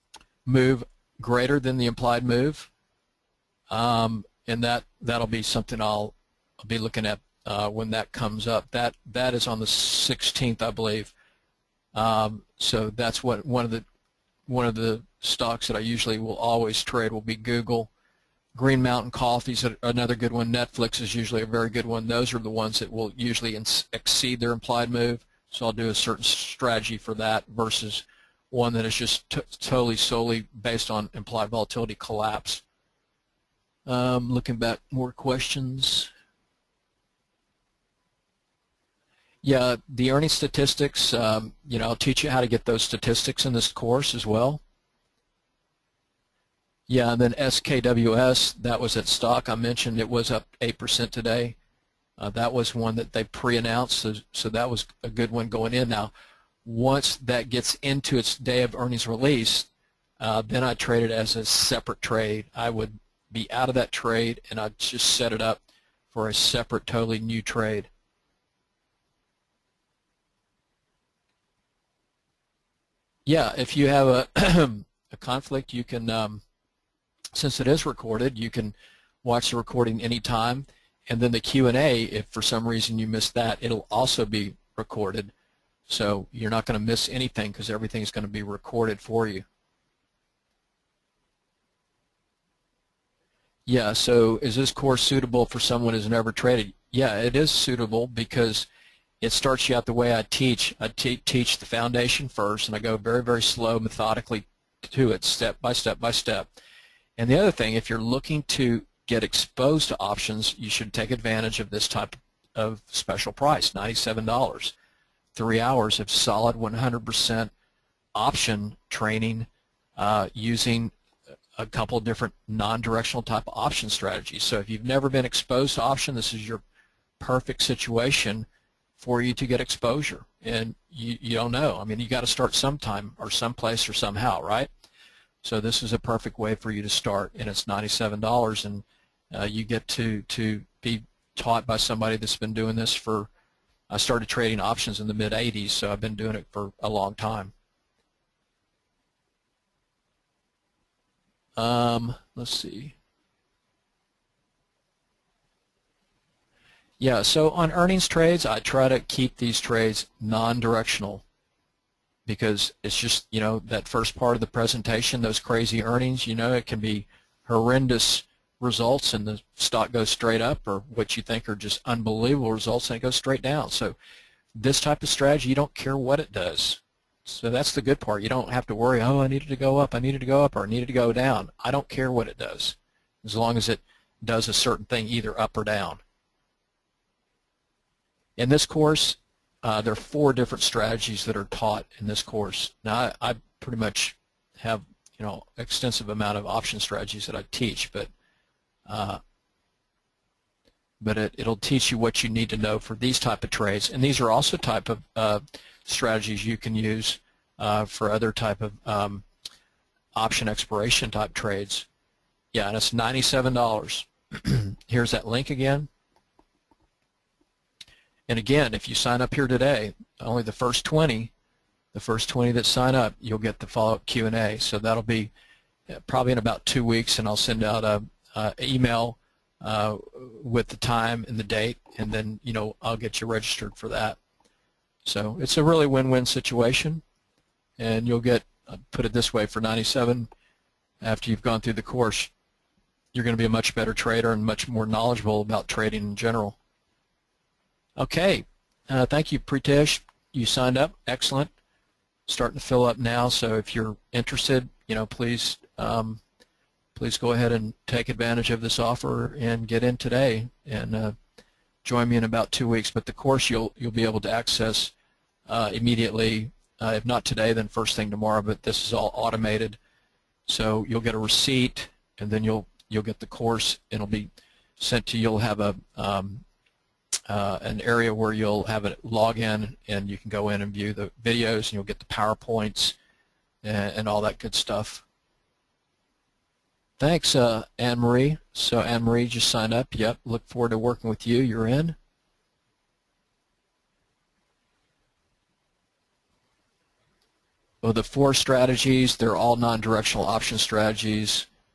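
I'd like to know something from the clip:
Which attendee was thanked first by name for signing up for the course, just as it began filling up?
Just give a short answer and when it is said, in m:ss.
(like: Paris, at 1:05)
Pritesh, at 4:09.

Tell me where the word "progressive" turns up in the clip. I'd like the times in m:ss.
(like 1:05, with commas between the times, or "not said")
not said.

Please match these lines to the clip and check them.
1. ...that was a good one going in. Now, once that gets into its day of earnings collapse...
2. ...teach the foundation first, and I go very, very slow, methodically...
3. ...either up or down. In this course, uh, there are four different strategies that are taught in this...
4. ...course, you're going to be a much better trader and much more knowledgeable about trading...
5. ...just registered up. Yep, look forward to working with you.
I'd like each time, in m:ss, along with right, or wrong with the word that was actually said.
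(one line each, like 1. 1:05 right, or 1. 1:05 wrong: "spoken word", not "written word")
1. 0:54 wrong: "release", not "collapse"
2. 1:41 right
3. 3:05 right
4. 4:01 right
5. 4:49 wrong: "signed", not "registered".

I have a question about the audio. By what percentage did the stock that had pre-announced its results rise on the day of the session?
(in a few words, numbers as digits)
8%.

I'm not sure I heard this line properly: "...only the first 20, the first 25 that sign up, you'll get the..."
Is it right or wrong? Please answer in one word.
wrong.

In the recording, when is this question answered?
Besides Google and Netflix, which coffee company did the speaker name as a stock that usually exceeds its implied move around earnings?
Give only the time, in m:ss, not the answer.
0:18.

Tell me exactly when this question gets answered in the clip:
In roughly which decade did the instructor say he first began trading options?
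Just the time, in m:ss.
2:25.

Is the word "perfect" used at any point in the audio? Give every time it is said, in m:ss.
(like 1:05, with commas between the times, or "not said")
2:07, 2:15.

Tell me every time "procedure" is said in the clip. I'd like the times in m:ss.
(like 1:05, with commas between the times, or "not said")
not said.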